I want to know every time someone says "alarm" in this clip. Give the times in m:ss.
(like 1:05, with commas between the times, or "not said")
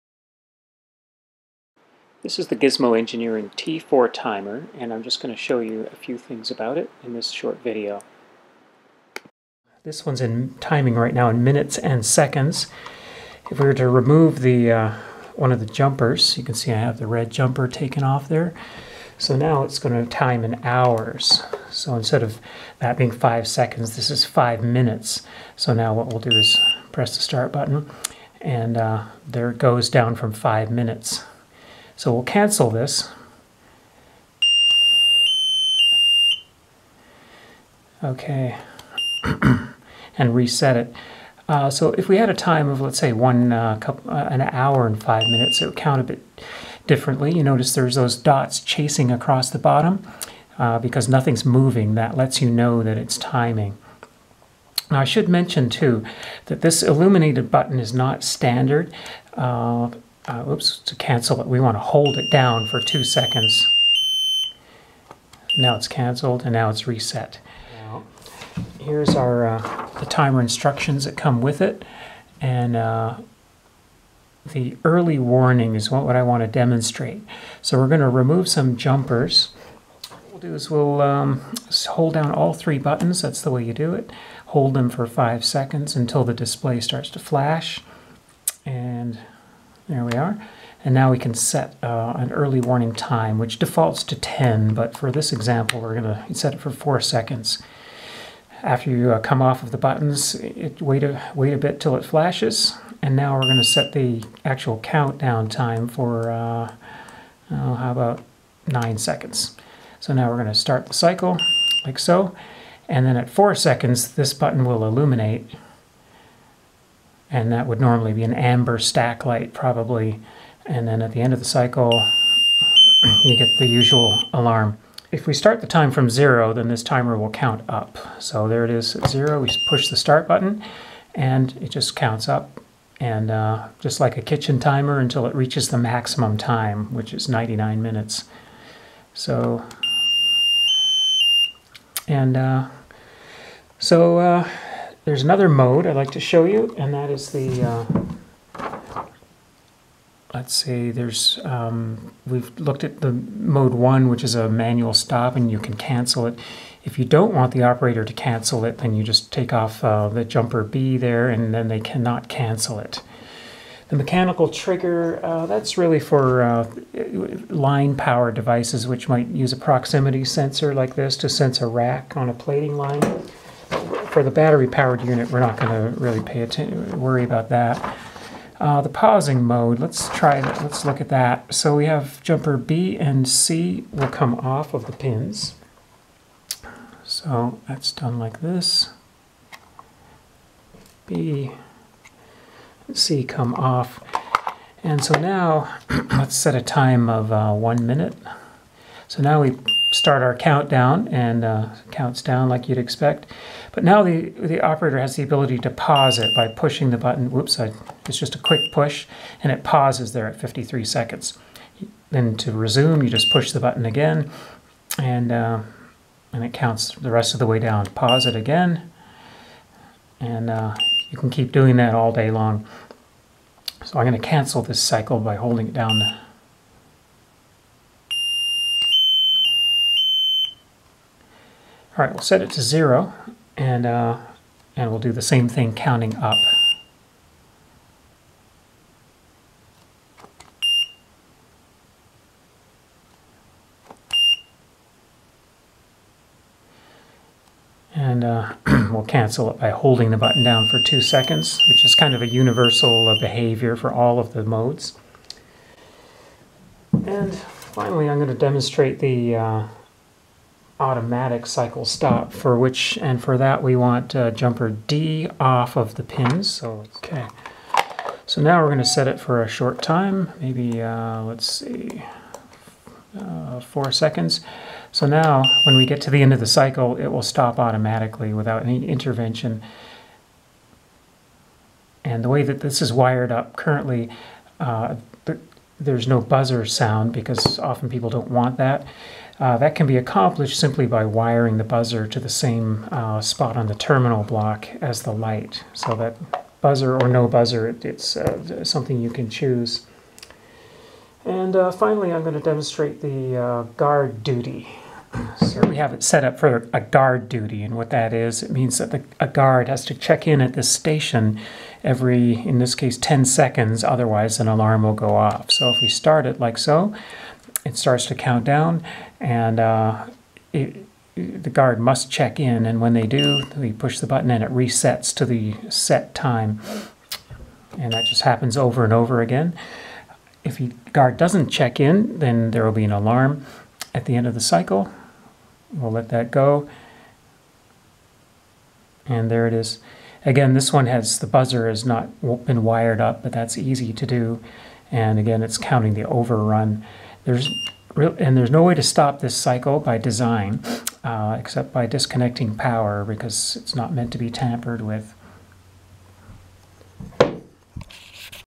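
2:04, 5:14, 5:32.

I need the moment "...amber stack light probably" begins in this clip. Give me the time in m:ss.
1:58.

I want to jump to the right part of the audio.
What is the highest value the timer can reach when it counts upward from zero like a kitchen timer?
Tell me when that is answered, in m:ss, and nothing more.
2:17.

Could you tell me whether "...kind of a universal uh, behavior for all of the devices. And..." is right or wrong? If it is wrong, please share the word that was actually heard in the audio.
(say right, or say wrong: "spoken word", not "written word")
wrong: "modes", not "devices".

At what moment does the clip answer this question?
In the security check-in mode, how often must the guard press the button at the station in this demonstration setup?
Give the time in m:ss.
5:12.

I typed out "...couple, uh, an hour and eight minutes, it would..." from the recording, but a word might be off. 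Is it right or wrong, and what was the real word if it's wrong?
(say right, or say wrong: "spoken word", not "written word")
wrong: "five", not "eight".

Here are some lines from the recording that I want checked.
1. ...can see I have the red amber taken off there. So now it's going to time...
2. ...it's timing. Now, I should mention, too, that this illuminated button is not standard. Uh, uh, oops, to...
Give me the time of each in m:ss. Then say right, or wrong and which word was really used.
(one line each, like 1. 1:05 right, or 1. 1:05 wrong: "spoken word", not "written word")
1. 0:16 wrong: "jumper", not "amber"
2. 0:52 right.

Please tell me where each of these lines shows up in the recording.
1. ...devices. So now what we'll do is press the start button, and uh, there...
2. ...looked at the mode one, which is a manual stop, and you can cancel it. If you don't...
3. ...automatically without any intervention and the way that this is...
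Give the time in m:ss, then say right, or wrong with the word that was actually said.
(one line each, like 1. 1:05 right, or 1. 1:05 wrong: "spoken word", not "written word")
1. 0:24 wrong: "minutes", not "devices"
2. 2:32 right
3. 4:37 right.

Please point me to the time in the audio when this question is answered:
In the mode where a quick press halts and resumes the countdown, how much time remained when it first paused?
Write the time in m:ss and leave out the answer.
3:30.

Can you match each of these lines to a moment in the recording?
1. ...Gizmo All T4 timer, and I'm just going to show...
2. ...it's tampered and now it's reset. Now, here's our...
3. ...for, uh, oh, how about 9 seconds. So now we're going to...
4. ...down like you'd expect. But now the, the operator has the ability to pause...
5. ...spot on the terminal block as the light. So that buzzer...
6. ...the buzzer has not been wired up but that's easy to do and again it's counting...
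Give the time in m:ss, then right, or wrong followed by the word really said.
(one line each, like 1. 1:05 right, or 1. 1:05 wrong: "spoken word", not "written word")
1. 0:02 wrong: "Engineering", not "All"
2. 1:05 wrong: "canceled", not "tampered"
3. 1:45 right
4. 3:22 right
5. 4:53 right
6. 5:41 right.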